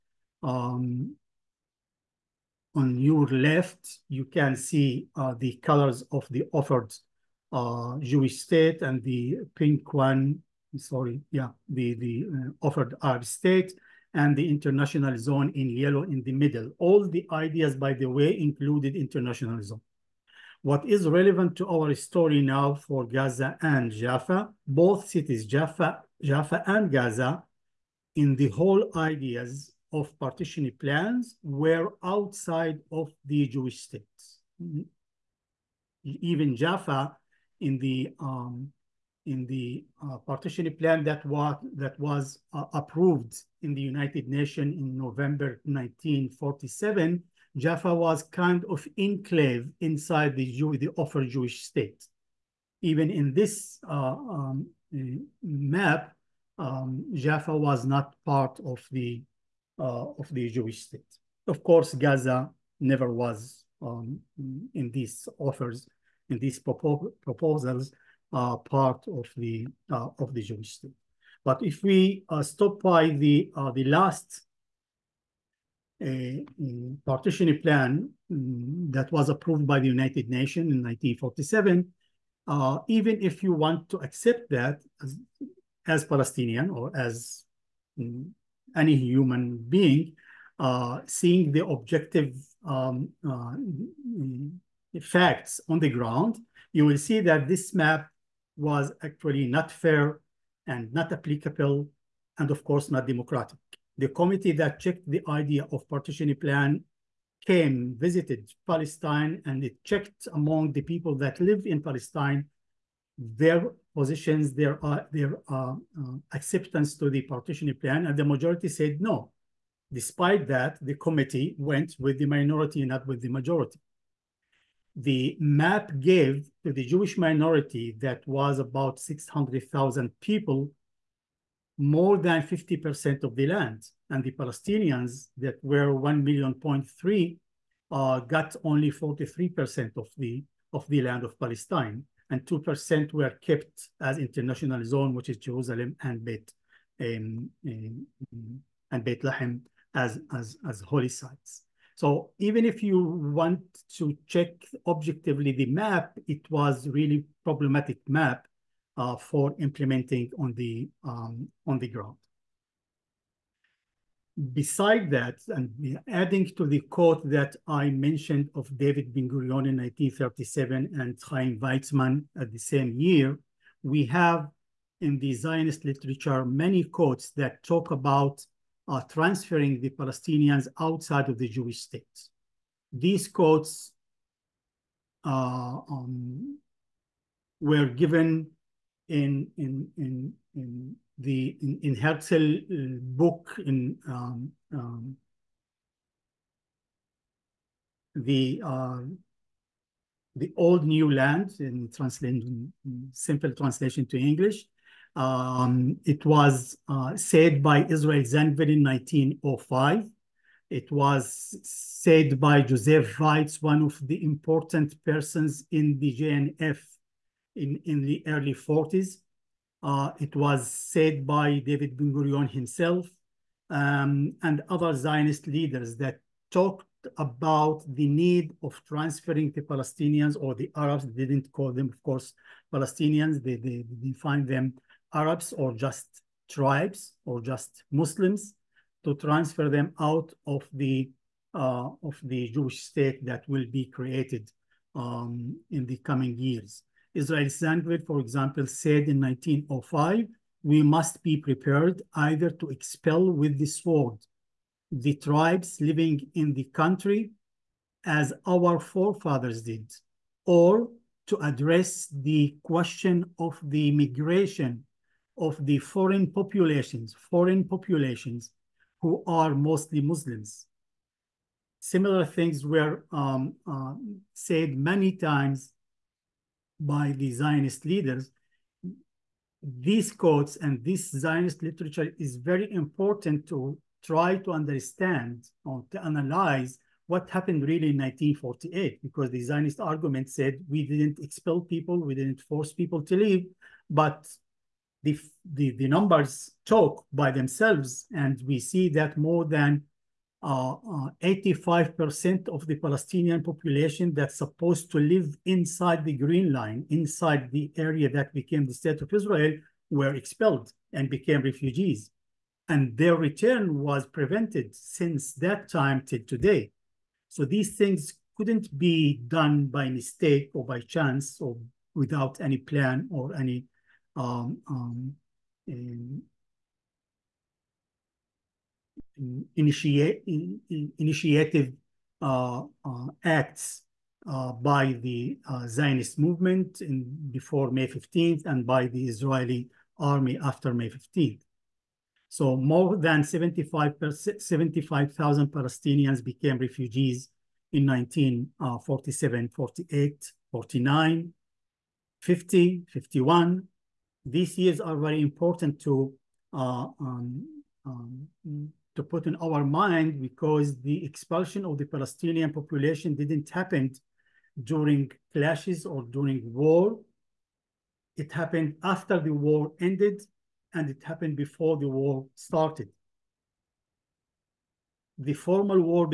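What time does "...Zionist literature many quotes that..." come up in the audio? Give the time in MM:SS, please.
02:55.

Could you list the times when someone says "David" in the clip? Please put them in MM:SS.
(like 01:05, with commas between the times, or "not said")
02:48, 03:41.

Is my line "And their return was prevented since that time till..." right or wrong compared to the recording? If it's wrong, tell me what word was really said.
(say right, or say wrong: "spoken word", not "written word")
right.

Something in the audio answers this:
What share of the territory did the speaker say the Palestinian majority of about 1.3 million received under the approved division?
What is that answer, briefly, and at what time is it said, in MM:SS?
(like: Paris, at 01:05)
43%, at 02:18.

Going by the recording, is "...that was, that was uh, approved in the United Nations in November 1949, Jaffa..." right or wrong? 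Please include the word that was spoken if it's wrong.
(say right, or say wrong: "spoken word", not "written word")
wrong: "1947", not "1949".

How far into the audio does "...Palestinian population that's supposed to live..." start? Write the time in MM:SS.
05:02.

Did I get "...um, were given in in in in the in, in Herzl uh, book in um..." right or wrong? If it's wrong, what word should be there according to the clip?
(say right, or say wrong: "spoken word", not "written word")
right.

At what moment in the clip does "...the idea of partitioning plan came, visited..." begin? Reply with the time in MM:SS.
01:45.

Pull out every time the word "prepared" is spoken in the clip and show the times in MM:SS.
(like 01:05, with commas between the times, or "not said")
04:11.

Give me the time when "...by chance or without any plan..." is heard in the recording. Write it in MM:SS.
05:20.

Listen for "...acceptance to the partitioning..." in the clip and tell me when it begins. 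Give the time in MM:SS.
01:56.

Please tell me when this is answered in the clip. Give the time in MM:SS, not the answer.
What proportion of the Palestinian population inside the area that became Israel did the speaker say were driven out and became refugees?
04:59.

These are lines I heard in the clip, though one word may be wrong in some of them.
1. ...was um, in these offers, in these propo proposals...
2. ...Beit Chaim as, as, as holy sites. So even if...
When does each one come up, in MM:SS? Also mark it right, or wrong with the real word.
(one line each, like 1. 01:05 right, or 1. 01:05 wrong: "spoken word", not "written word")
1. 01:03 right
2. 02:29 wrong: "Lahem", not "Chaim".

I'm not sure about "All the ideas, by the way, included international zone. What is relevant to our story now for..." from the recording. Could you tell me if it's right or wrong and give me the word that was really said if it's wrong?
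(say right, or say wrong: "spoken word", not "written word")
right.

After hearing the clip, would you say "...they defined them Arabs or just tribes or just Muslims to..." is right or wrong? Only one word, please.
right.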